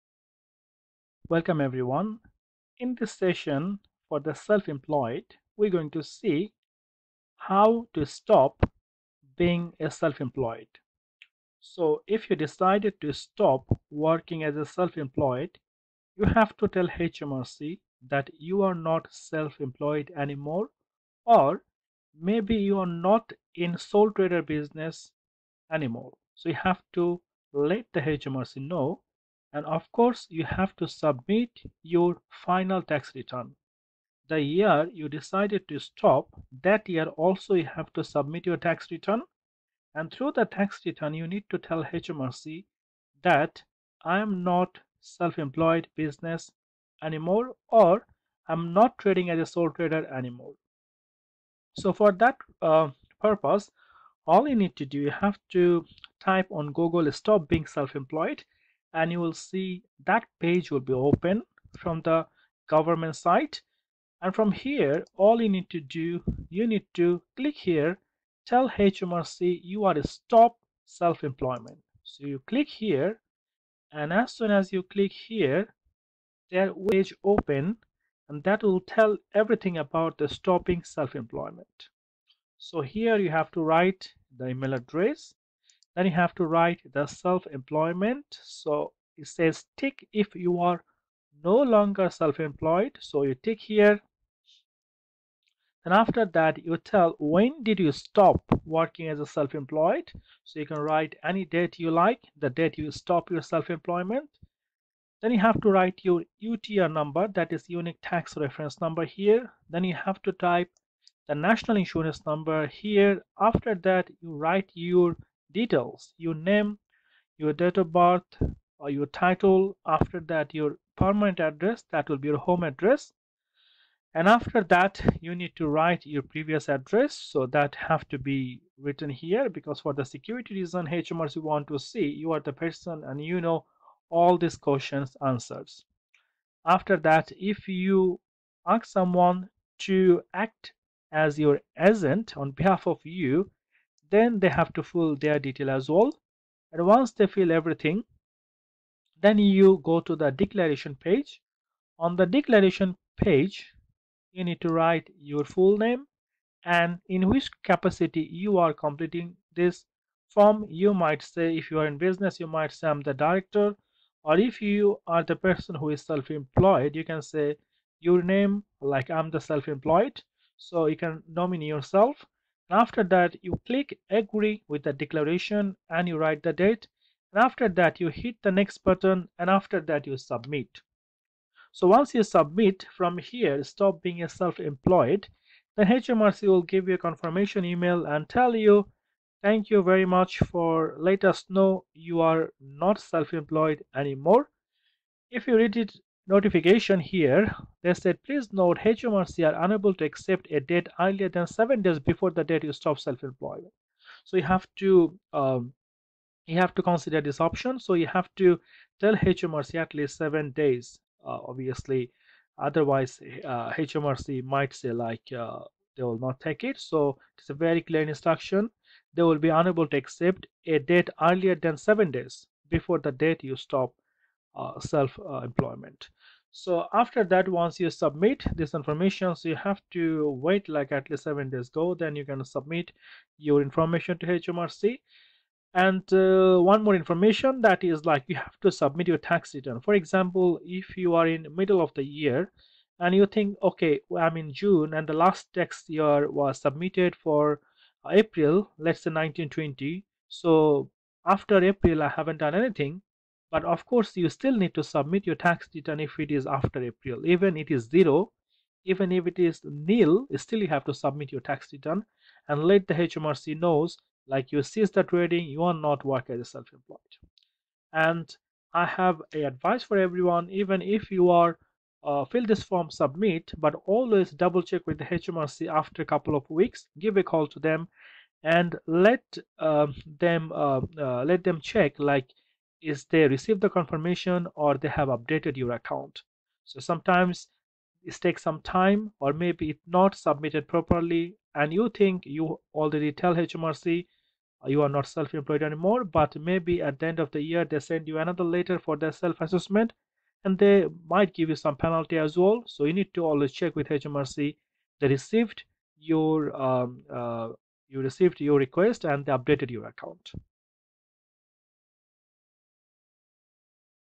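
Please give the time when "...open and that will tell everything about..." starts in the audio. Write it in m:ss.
1:17.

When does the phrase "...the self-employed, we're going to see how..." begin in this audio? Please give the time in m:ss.
0:04.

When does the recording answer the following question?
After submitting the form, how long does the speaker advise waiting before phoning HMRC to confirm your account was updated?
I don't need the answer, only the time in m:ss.
4:36.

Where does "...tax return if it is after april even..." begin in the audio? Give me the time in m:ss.
4:15.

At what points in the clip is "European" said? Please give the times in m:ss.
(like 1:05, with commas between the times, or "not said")
not said.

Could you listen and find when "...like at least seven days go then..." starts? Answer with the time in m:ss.
3:50.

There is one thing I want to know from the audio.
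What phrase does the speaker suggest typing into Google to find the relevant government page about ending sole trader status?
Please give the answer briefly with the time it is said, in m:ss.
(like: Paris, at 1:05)
stop being self-employed, at 0:57.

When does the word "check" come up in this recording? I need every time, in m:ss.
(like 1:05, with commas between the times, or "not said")
4:34, 4:41, 5:03.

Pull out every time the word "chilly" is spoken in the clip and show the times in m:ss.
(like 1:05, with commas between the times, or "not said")
not said.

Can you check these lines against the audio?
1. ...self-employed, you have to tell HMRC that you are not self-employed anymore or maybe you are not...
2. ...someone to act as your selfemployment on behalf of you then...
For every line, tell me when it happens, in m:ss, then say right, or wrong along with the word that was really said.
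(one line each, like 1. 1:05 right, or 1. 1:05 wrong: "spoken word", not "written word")
1. 0:14 right
2. 2:18 wrong: "agent", not "selfemployment".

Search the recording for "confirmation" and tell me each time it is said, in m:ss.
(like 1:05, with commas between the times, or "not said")
3:07, 4:43.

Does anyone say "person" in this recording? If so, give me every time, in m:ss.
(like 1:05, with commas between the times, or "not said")
2:12, 2:45.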